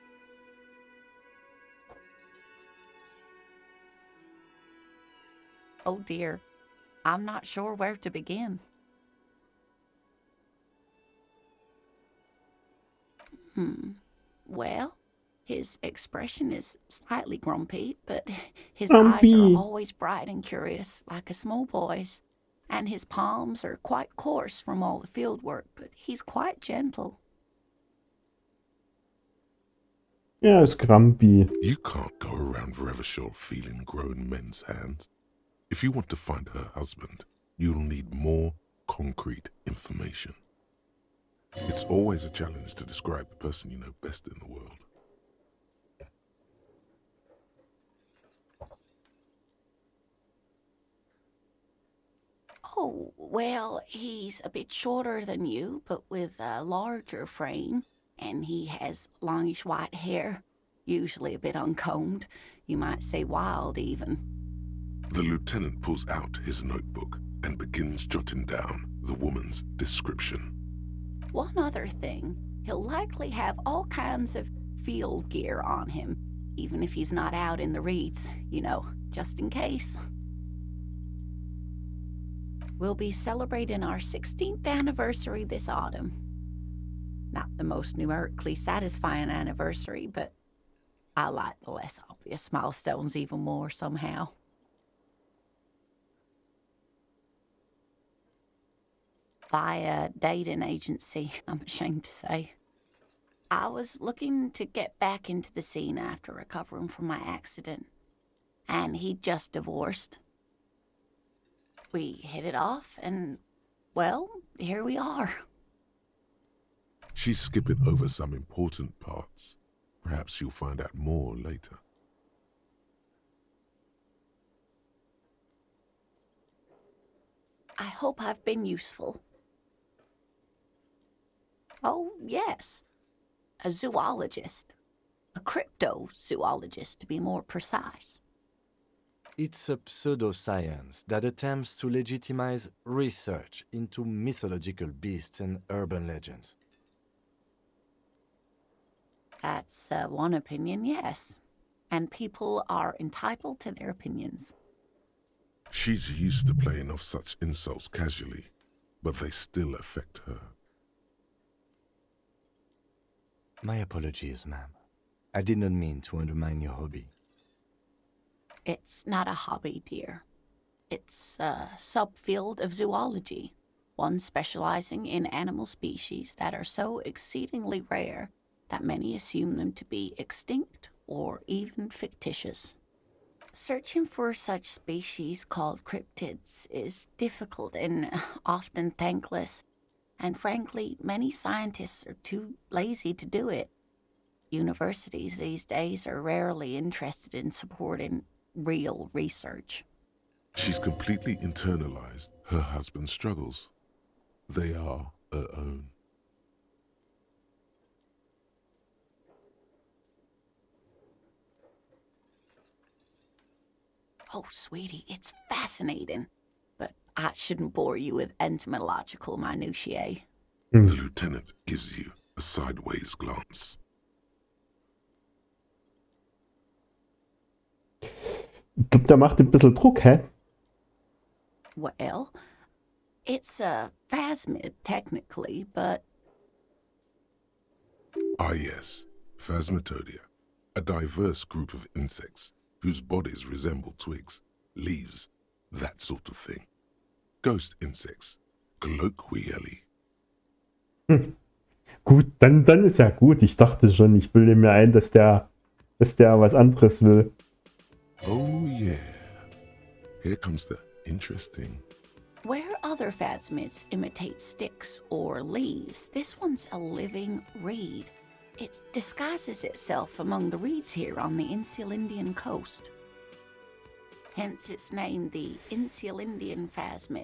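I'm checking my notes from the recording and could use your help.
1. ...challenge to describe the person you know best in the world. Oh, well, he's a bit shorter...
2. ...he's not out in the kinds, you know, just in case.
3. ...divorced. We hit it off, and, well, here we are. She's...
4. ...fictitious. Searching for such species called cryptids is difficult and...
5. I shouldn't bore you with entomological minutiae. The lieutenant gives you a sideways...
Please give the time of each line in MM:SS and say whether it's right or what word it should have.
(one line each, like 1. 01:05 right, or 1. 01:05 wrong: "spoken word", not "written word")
1. 00:42 right
2. 01:16 wrong: "reeds", not "kinds"
3. 01:49 right
4. 03:01 right
5. 03:37 right.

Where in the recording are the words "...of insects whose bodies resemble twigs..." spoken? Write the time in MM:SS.
04:01.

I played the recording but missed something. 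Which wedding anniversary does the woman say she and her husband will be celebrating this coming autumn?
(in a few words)
16th.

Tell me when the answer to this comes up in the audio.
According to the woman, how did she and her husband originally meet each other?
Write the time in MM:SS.
01:40.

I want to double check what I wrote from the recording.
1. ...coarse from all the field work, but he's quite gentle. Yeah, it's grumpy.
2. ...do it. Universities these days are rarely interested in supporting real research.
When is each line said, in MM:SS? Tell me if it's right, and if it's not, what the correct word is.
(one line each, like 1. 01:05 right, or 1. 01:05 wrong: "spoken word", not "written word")
1. 00:24 right
2. 03:13 right.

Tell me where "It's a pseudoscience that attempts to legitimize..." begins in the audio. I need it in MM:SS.
02:19.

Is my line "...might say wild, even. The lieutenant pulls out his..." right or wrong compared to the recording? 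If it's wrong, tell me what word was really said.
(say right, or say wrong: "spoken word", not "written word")
right.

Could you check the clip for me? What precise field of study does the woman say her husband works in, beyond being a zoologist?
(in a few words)
Cryptozoologist.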